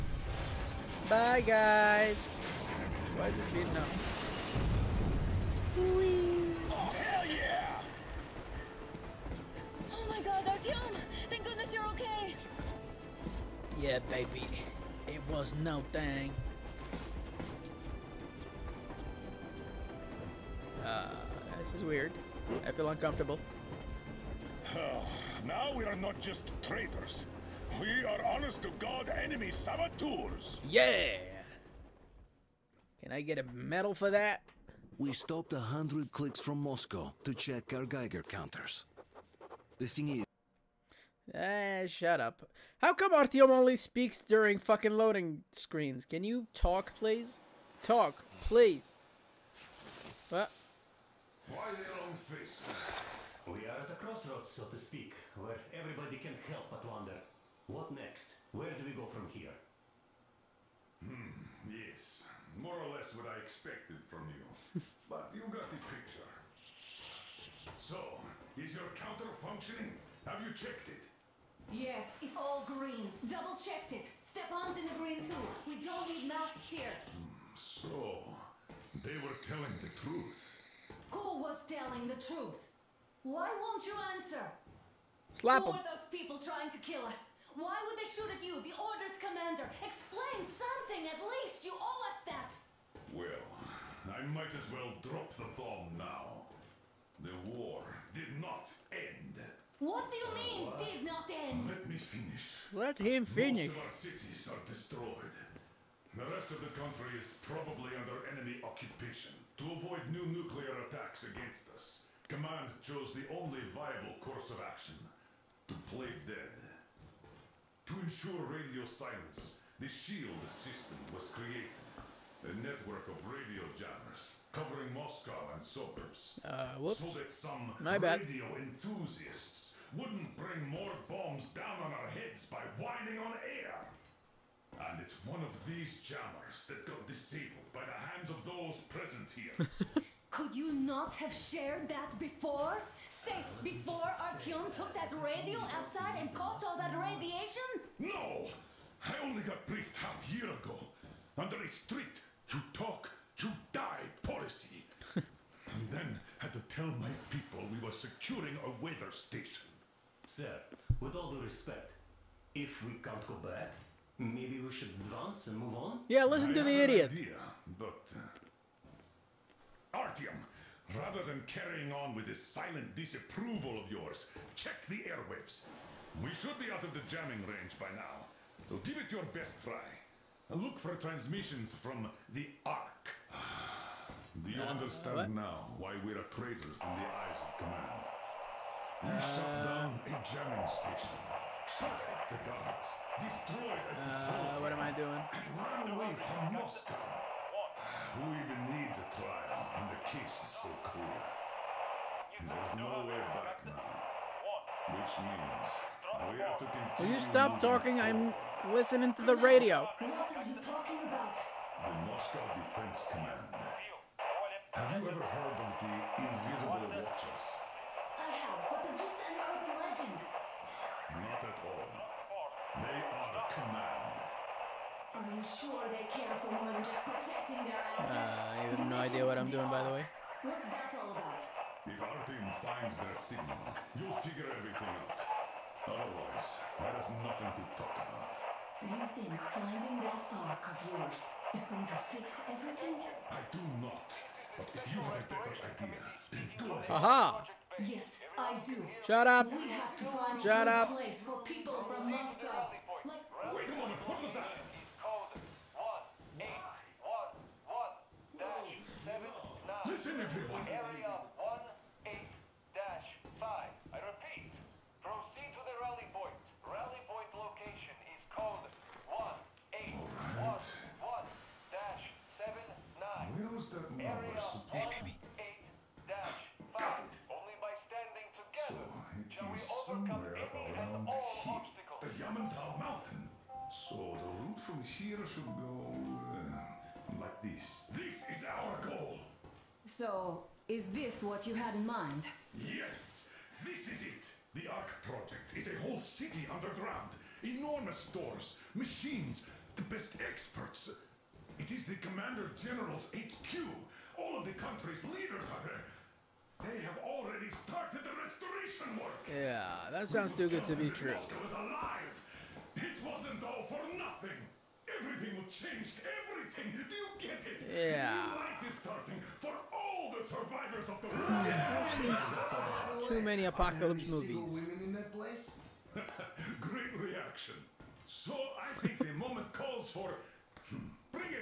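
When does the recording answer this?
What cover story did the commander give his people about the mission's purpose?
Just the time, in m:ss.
2:37.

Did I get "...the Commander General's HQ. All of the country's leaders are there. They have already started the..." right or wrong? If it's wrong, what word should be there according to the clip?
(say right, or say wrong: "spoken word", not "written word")
right.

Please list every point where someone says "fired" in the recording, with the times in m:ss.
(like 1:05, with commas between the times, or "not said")
not said.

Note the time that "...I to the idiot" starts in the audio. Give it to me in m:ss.
2:46.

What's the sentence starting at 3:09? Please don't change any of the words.
We uh, shut down a jamming station, shut up the guards, destroyed a uh, What am I doing?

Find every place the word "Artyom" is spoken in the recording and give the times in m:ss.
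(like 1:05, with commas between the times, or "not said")
0:10, 0:43, 2:24, 2:49.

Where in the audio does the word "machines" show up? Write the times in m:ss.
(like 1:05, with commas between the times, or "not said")
4:58.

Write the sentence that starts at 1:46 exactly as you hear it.
The rest of the country is probably under enemy occupation to avoid new nuclear attacks against us.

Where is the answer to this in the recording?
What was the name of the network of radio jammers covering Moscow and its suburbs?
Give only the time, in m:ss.
1:59.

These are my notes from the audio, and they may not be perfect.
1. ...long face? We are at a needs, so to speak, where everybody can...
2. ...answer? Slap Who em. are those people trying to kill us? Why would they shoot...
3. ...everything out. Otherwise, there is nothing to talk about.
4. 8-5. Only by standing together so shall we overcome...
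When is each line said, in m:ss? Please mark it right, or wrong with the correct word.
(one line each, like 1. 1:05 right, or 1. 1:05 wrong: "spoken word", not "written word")
1. 0:52 wrong: "crossroads", not "needs"
2. 1:24 right
3. 3:54 right
4. 4:35 right.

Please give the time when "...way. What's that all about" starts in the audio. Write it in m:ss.
3:49.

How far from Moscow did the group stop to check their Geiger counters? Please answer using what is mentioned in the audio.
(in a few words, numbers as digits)
100 clicks.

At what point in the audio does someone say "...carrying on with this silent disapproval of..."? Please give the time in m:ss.
2:51.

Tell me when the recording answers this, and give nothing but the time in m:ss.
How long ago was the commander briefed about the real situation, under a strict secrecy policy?
2:29.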